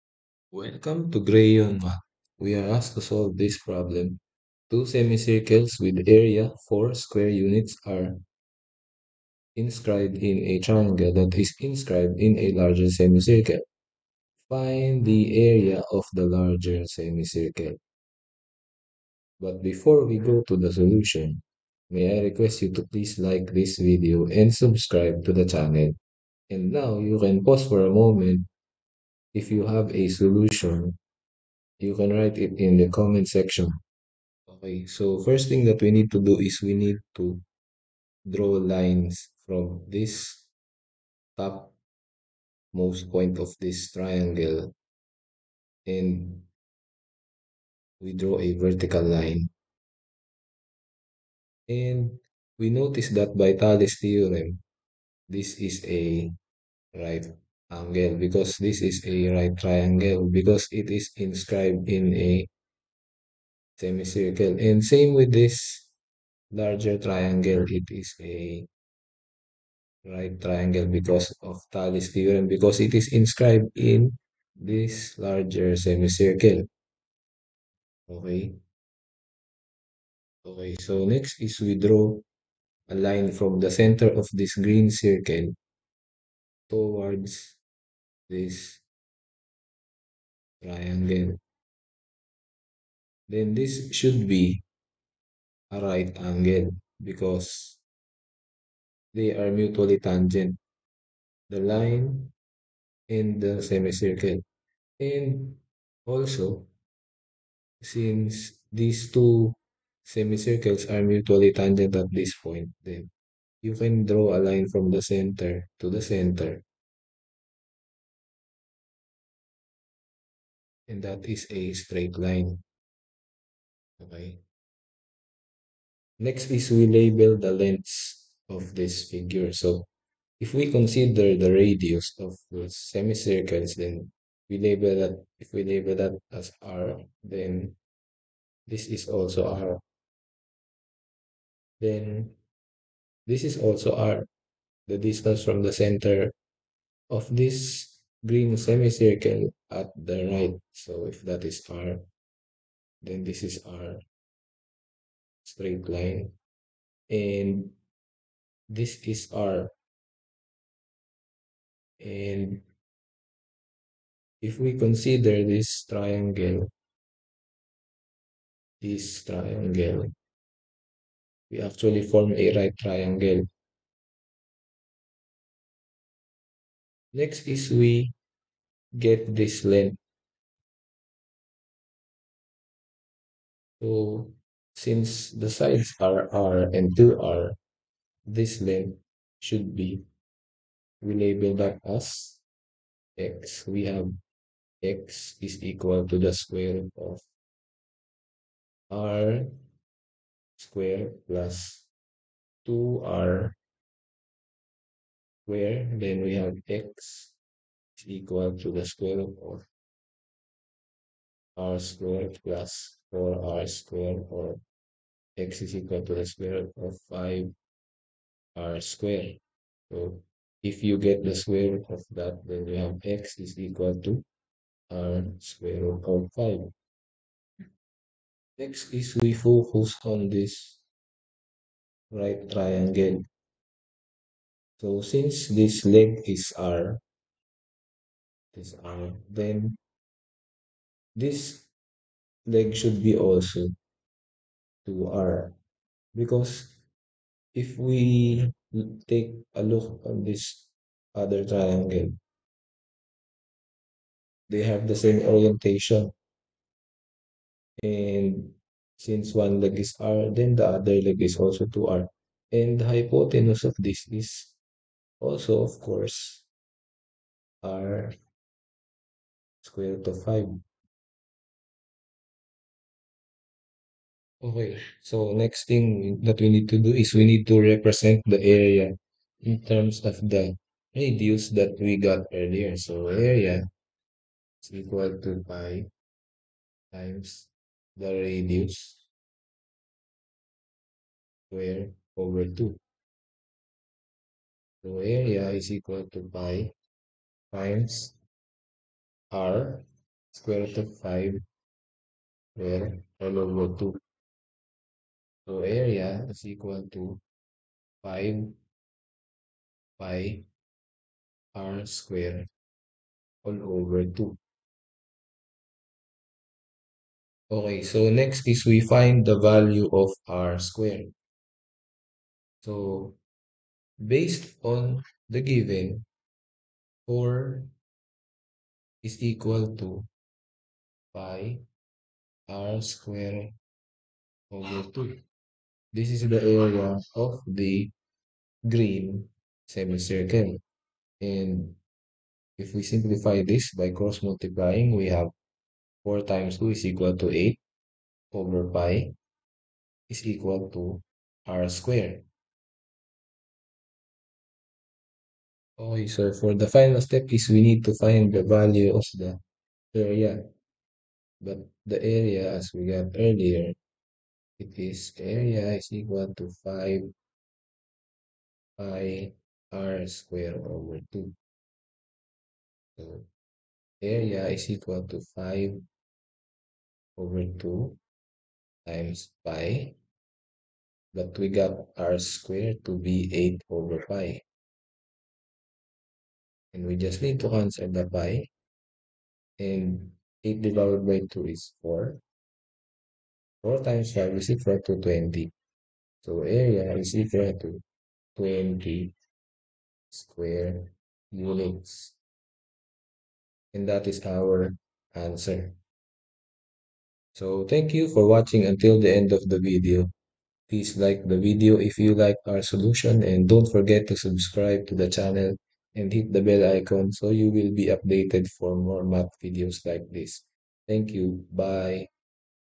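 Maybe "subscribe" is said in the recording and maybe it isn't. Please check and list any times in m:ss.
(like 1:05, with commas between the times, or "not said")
0:24, 6:54.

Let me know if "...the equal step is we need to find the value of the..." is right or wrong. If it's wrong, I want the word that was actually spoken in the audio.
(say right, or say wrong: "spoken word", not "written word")
wrong: "final", not "equal".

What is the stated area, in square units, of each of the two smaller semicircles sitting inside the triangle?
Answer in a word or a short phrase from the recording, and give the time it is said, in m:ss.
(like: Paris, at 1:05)
4, at 0:06.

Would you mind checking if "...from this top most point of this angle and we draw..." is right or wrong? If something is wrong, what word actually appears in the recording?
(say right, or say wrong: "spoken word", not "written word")
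wrong: "triangle", not "angle".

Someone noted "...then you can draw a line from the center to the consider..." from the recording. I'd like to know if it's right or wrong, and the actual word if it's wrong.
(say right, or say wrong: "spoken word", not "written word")
wrong: "center", not "consider".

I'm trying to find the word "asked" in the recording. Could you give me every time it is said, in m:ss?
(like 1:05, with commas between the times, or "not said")
0:02.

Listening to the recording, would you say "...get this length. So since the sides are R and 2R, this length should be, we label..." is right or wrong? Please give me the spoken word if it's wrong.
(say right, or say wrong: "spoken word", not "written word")
right.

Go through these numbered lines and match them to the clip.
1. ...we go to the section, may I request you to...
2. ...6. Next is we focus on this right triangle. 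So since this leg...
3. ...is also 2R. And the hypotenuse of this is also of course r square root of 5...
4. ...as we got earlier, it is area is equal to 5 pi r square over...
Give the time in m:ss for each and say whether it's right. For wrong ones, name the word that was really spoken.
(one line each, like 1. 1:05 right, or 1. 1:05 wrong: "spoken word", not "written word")
1. 0:20 wrong: "solution", not "section"
2. 3:46 wrong: "5", not "6"
3. 4:21 right
4. 6:02 right.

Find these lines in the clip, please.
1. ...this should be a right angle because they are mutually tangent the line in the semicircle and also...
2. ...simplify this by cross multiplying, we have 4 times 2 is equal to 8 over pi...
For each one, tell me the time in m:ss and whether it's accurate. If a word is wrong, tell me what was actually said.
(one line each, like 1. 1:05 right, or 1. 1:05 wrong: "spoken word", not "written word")
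1. 1:33 right
2. 5:42 right.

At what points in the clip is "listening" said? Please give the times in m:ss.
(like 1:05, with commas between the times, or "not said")
not said.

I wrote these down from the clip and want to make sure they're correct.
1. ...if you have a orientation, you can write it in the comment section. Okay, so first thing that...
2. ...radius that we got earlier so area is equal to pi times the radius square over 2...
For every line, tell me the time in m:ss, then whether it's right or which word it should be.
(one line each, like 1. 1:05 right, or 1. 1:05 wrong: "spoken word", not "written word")
1. 0:29 wrong: "solution", not "orientation"
2. 4:40 right.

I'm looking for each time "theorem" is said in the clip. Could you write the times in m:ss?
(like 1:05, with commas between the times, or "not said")
0:53, 1:12.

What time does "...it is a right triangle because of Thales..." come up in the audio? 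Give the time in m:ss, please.
1:07.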